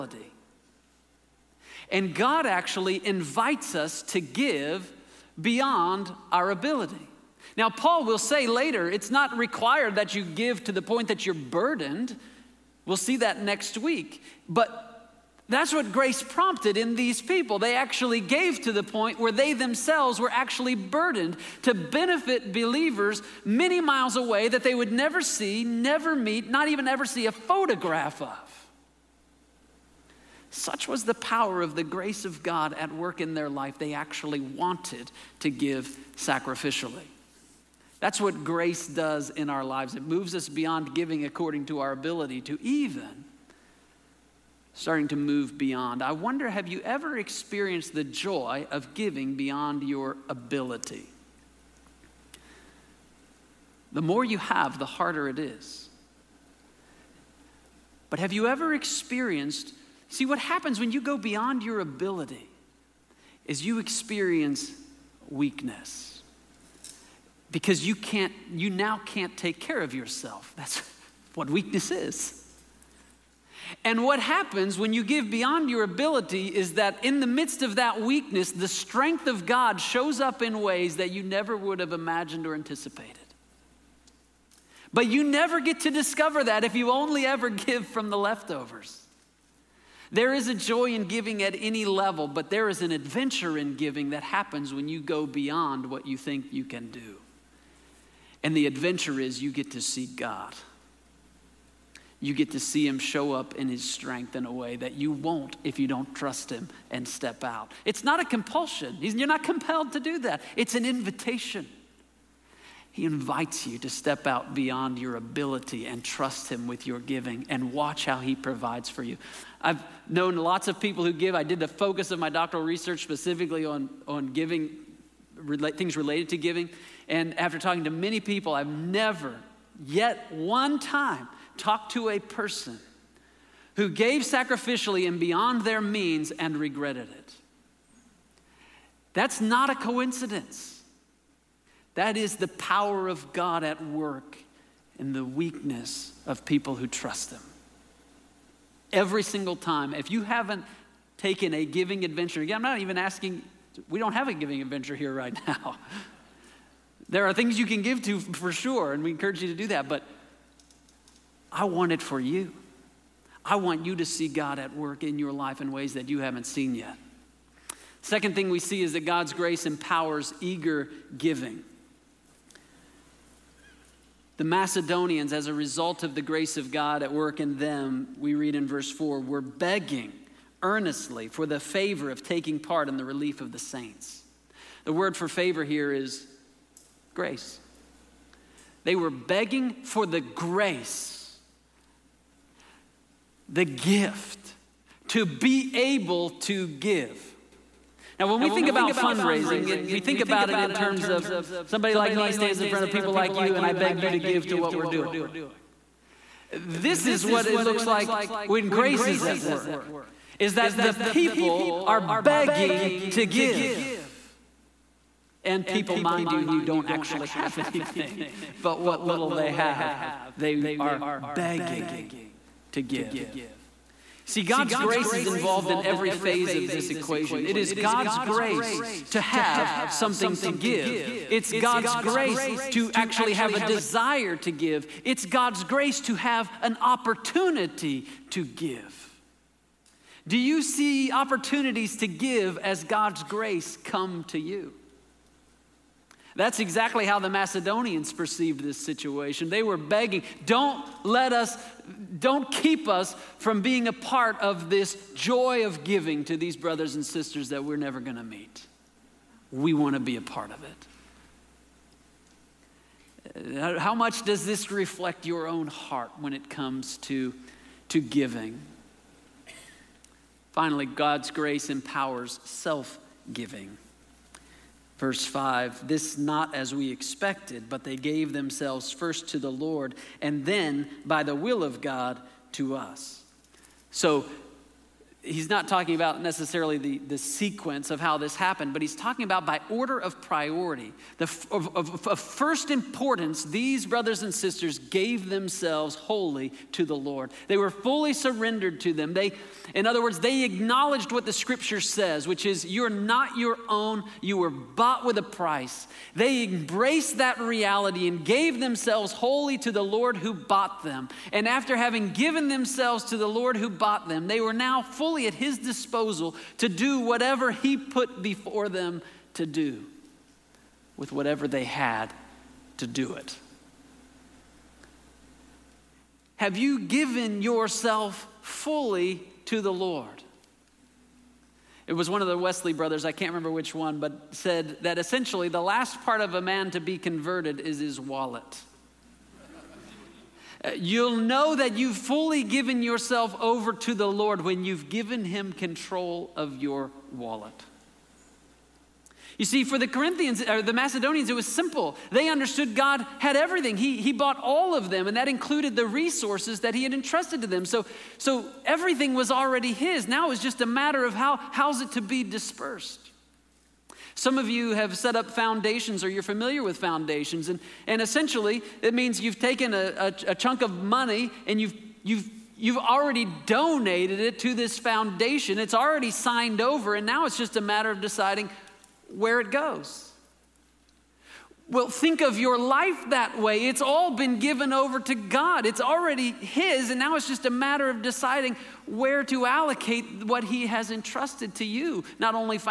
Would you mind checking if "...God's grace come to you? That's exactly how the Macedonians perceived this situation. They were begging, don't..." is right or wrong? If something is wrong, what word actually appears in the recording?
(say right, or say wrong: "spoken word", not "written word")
right.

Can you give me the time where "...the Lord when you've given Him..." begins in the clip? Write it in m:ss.
5:43.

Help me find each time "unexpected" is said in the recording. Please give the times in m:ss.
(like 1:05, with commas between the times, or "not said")
not said.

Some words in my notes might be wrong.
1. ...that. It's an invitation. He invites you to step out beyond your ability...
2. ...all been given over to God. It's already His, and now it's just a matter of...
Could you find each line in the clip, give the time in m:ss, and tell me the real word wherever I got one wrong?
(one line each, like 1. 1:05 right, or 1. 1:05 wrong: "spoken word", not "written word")
1. 1:50 right
2. 6:23 right.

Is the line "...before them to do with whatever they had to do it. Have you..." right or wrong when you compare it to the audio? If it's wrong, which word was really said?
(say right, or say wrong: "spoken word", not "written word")
right.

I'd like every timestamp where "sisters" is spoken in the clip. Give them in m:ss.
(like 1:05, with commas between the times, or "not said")
4:17, 4:54.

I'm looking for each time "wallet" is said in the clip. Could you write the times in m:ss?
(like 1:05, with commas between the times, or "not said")
5:37, 5:47.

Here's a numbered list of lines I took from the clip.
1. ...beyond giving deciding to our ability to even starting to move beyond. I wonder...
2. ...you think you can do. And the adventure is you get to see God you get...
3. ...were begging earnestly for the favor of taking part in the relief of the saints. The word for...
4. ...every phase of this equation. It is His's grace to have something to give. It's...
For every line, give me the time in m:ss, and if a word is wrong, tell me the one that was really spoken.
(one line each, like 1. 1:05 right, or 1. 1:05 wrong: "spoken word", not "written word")
1. 0:40 wrong: "according", not "deciding"
2. 1:36 right
3. 2:59 right
4. 3:45 wrong: "God", not "His".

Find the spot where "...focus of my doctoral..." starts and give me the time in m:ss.
2:01.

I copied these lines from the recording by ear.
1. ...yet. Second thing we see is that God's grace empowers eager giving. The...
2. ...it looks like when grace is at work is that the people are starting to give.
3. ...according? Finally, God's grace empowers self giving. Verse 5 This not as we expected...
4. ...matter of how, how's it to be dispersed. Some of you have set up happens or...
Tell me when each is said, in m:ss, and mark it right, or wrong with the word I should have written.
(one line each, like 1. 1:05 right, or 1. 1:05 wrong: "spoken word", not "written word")
1. 2:46 right
2. 3:27 wrong: "begging", not "starting"
3. 4:27 wrong: "giving", not "according"
4. 6:00 wrong: "foundations", not "happens".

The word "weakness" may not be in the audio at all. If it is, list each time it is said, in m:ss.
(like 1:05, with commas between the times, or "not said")
1:05, 1:11, 1:17, 2:25.